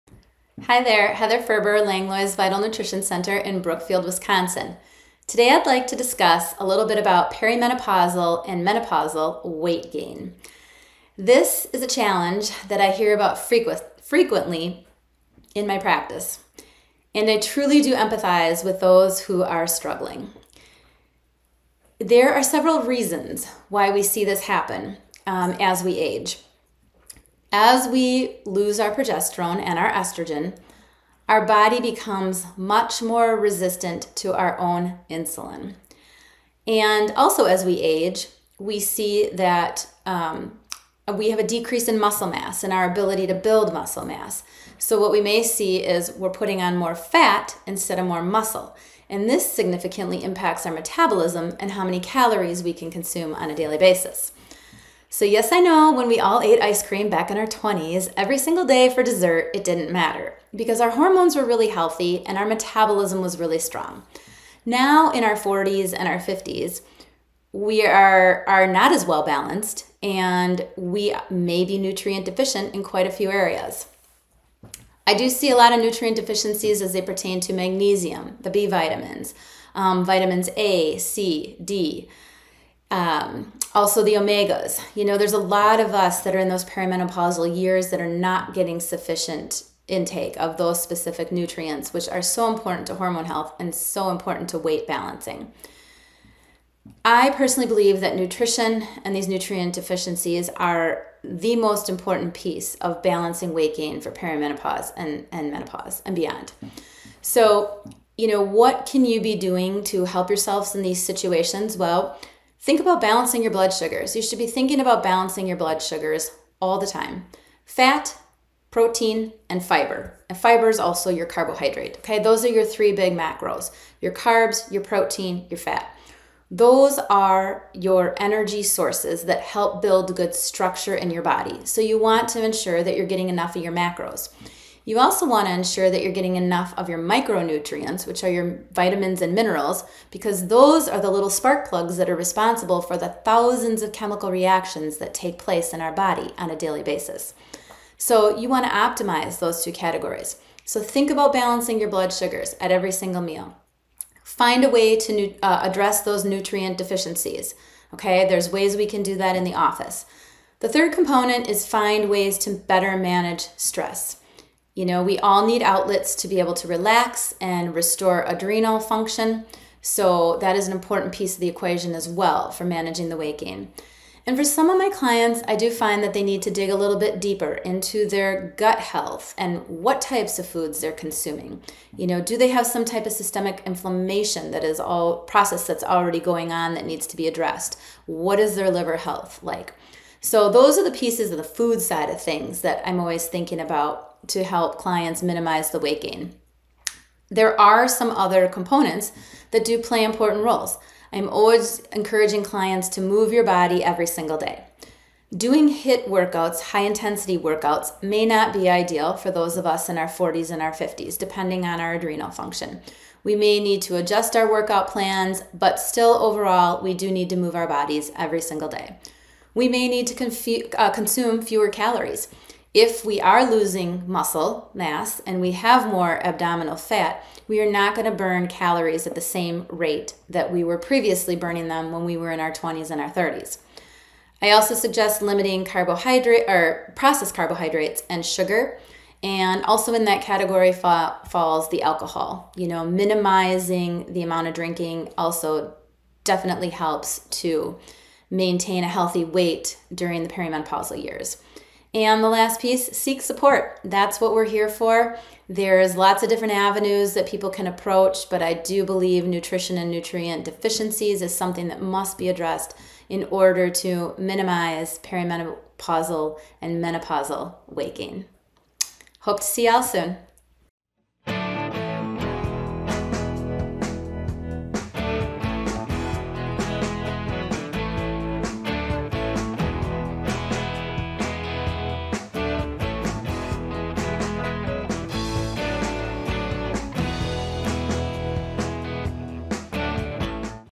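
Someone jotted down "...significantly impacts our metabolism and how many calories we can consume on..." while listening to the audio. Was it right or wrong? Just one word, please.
right.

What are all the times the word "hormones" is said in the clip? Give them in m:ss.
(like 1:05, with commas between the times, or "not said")
1:00, 1:32.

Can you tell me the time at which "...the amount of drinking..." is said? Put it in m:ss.
4:04.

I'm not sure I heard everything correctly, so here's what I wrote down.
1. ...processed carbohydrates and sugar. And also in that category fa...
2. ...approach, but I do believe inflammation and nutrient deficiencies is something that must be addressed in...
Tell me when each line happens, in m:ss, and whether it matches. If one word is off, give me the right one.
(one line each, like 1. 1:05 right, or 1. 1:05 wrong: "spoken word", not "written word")
1. 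3:56 right
2. 4:17 wrong: "nutrition", not "inflammation".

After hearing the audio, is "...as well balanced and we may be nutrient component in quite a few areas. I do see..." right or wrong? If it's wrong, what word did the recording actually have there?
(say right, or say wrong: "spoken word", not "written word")
wrong: "deficient", not "component".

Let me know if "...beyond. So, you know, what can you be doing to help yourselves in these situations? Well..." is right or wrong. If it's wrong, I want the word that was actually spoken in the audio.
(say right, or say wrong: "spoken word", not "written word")
right.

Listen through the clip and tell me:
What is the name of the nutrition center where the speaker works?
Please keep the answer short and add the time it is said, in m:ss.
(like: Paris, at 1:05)
Langlois Vital Nutrition Center, at 0:01.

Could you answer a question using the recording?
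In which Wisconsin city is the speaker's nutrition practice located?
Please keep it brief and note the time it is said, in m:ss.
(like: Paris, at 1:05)
Brookfield, at 0:03.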